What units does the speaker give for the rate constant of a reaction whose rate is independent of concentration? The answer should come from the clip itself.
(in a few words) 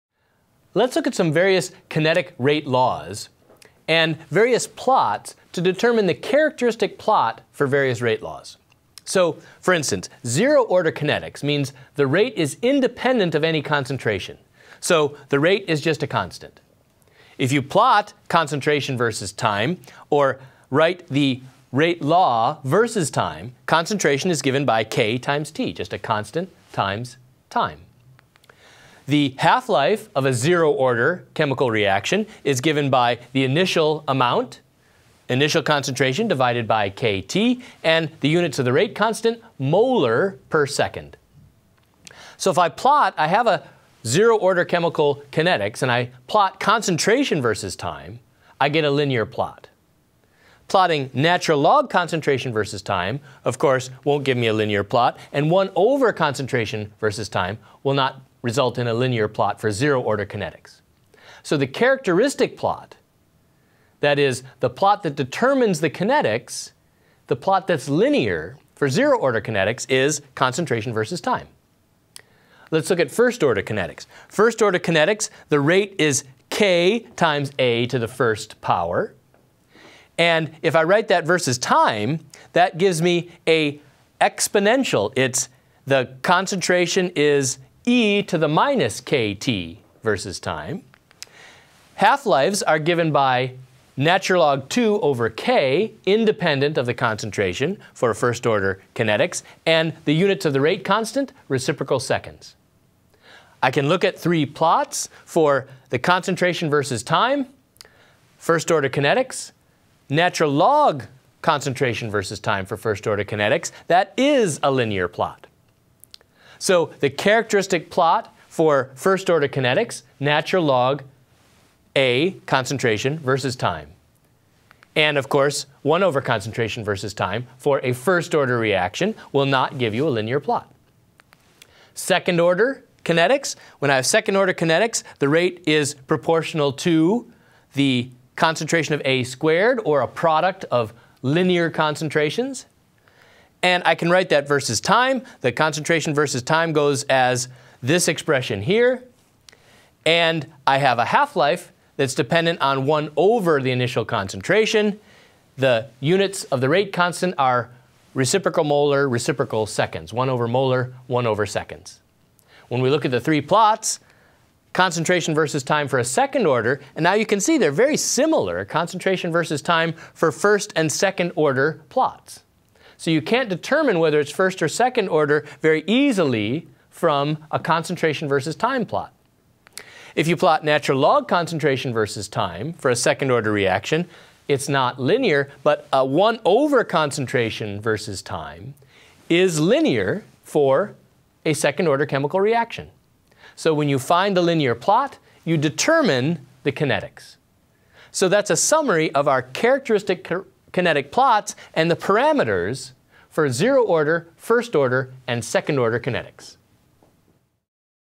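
molar per second.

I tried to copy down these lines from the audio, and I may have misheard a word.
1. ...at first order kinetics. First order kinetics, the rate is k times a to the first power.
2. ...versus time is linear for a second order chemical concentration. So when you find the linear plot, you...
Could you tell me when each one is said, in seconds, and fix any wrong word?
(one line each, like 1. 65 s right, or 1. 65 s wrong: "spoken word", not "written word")
1. 72 s right
2. 187 s wrong: "reaction", not "concentration".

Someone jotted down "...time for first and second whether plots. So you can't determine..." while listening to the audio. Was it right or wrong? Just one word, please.
wrong.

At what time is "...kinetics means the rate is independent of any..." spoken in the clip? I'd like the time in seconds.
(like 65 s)
10 s.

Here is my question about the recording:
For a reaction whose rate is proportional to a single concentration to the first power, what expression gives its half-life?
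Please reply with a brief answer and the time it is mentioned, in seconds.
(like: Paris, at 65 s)
ln 2 over k, at 93 s.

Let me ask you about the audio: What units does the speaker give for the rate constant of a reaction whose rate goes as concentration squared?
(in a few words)
reciprocal molar, reciprocal seconds.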